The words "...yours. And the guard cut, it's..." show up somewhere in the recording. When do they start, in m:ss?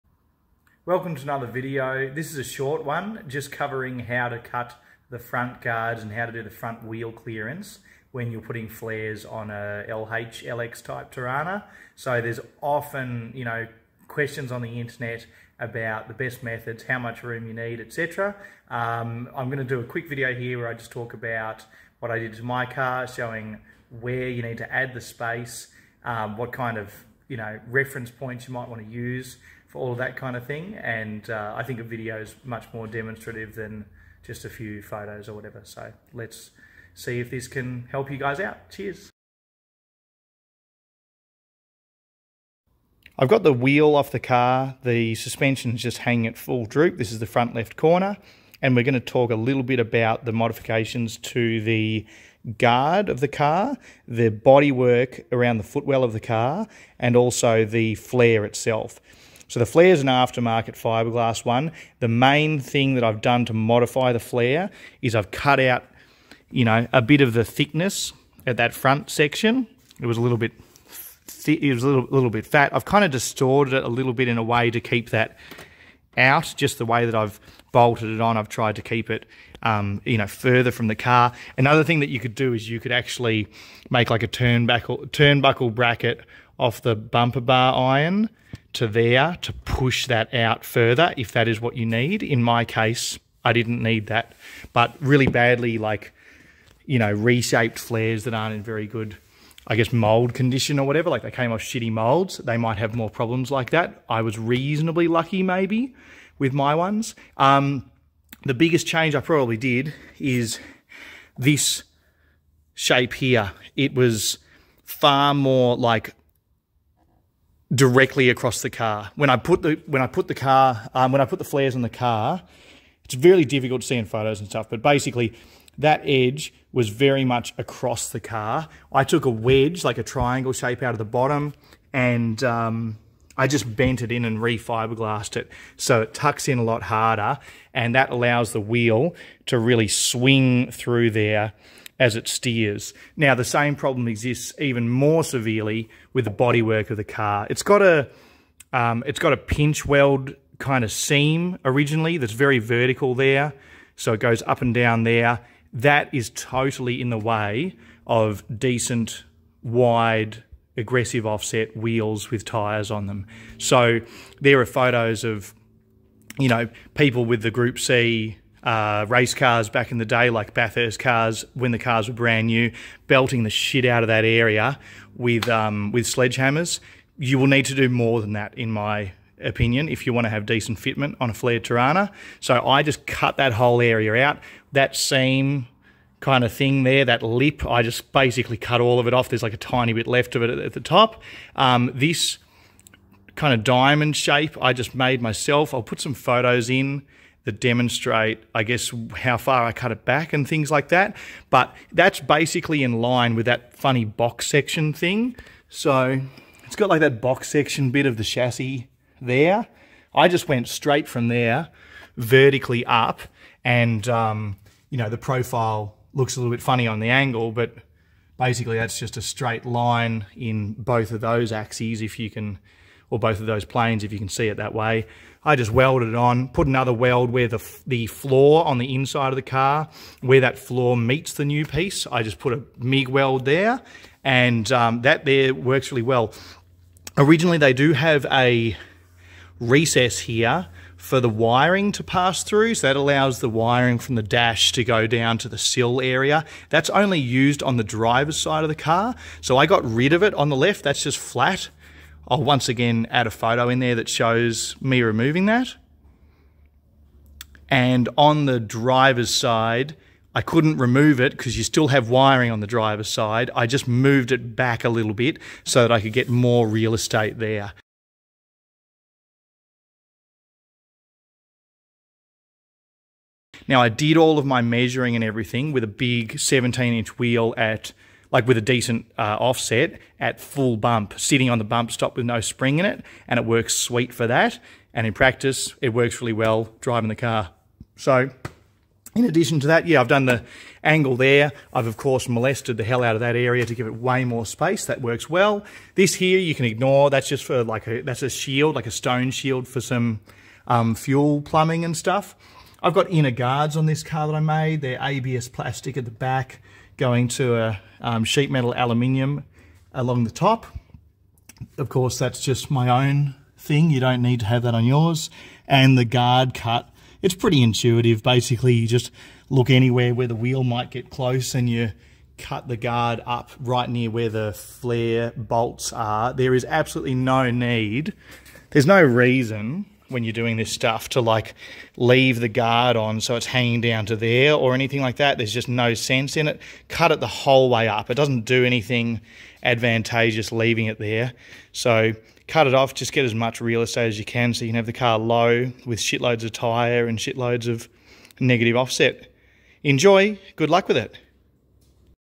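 5:14.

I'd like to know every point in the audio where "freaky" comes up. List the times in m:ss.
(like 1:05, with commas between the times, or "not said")
not said.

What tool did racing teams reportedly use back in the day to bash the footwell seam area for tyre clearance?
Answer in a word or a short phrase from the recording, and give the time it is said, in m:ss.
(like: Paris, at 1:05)
Sledgehammers, at 2:56.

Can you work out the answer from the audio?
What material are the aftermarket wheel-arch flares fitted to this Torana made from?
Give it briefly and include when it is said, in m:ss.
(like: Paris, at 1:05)
Fiberglass, at 1:00.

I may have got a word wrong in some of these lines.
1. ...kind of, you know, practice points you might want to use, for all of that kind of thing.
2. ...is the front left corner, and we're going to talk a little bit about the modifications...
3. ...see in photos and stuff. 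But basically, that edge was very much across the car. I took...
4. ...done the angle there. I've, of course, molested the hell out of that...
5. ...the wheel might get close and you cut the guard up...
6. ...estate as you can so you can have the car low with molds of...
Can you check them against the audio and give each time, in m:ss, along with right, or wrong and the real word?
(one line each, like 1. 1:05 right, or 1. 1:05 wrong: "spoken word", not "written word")
1. 0:26 wrong: "reference", not "practice"
2. 0:47 right
3. 2:03 right
4. 4:50 right
5. 5:20 right
6. 5:43 wrong: "shitloads", not "molds".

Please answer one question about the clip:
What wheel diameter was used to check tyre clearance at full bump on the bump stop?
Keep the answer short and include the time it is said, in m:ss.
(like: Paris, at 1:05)
17 inch, at 4:36.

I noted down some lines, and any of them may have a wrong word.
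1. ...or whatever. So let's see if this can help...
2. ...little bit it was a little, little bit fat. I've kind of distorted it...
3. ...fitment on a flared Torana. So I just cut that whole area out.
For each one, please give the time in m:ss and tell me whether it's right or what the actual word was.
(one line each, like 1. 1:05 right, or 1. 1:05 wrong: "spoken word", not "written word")
1. 0:35 right
2. 1:10 right
3. 3:00 right.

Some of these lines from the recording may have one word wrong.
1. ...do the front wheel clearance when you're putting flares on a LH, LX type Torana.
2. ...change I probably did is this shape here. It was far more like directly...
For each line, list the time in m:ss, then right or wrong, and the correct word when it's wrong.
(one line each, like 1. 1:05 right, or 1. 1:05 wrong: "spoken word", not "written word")
1. 0:06 right
2. 1:48 right.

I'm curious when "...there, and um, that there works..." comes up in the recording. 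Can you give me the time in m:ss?
3:53.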